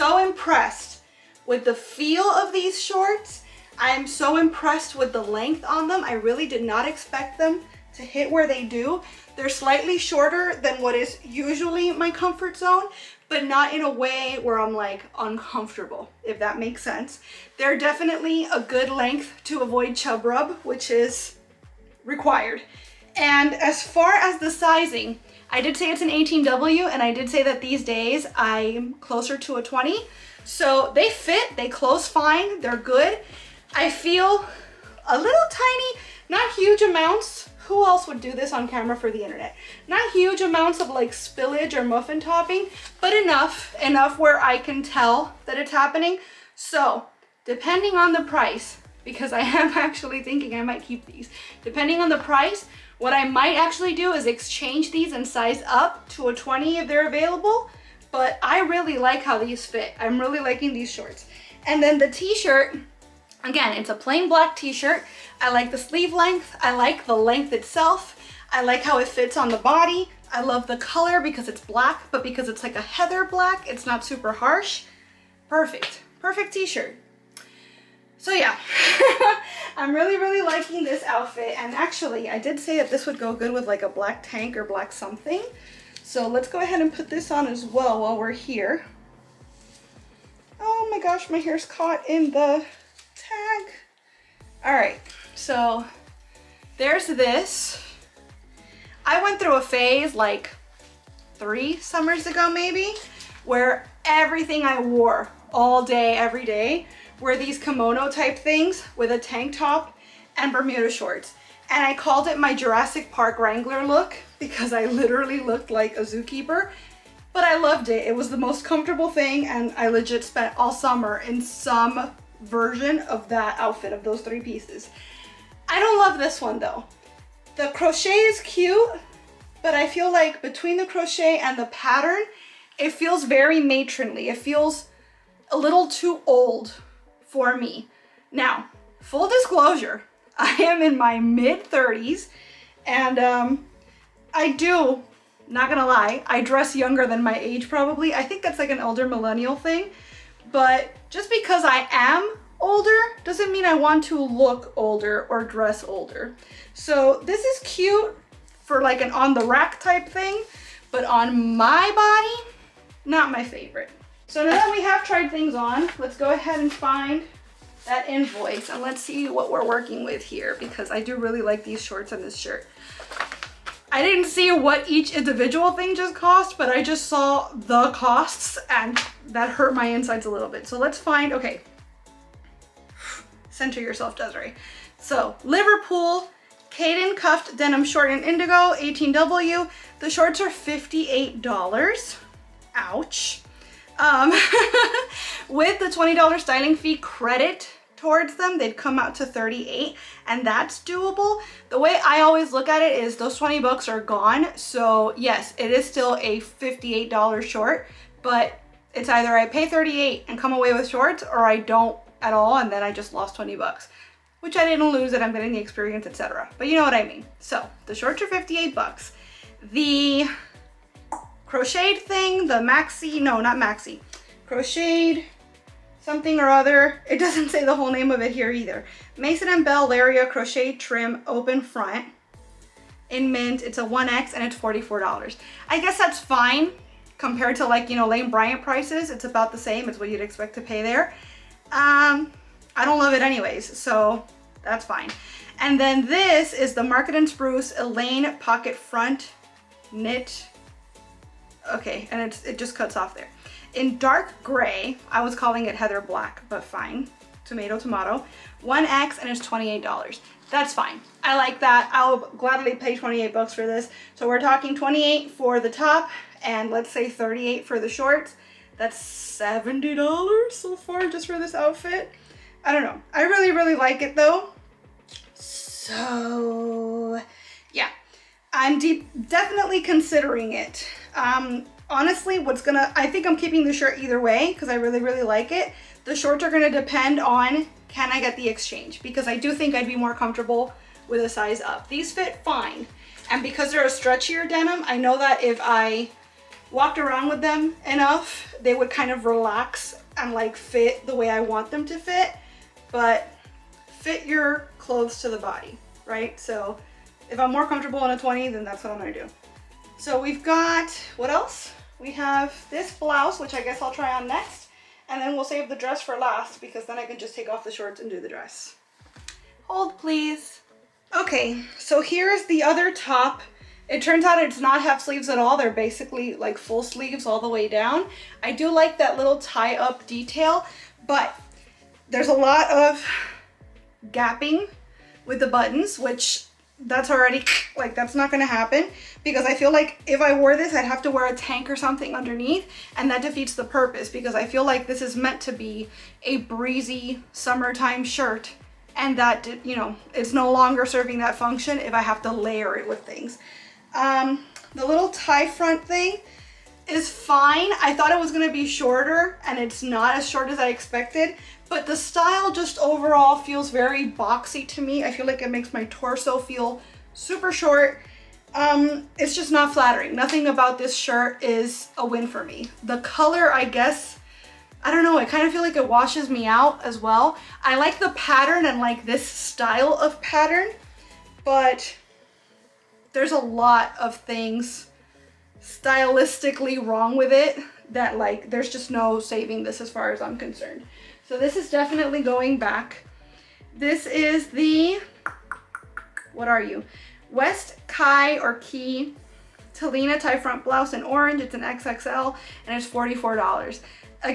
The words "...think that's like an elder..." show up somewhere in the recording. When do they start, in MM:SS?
02:28.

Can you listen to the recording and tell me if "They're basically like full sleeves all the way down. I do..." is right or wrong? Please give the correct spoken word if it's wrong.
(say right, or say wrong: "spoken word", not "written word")
right.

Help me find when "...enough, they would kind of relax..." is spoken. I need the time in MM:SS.
04:57.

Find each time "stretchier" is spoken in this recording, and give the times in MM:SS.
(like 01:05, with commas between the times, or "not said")
04:53.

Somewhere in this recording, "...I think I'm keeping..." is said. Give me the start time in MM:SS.
04:42.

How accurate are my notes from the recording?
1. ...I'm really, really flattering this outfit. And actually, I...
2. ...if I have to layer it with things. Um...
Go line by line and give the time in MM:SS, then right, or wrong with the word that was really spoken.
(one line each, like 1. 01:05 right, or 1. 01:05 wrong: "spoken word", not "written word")
1. 01:19 wrong: "liking", not "flattering"
2. 05:51 right.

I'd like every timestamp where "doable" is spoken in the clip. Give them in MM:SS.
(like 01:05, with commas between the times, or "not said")
03:20.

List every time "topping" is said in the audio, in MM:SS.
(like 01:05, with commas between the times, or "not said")
00:42.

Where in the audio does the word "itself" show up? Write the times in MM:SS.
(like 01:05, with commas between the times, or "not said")
01:07.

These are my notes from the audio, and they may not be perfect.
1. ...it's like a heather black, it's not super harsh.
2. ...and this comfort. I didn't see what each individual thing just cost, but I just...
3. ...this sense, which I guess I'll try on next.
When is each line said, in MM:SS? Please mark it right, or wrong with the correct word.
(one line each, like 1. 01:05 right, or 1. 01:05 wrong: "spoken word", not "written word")
1. 01:12 right
2. 02:52 wrong: "shirt", not "comfort"
3. 05:12 wrong: "blouse", not "sense".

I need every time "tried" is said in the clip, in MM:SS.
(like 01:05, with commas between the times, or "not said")
02:45.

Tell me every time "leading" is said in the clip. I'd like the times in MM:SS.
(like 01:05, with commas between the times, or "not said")
not said.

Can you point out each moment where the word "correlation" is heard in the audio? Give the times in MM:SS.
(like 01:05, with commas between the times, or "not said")
not said.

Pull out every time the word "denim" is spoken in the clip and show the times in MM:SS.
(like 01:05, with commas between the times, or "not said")
03:07, 04:54.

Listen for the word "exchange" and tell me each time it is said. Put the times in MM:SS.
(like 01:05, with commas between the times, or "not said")
00:54, 04:48.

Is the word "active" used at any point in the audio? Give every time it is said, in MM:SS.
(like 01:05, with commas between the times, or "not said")
not said.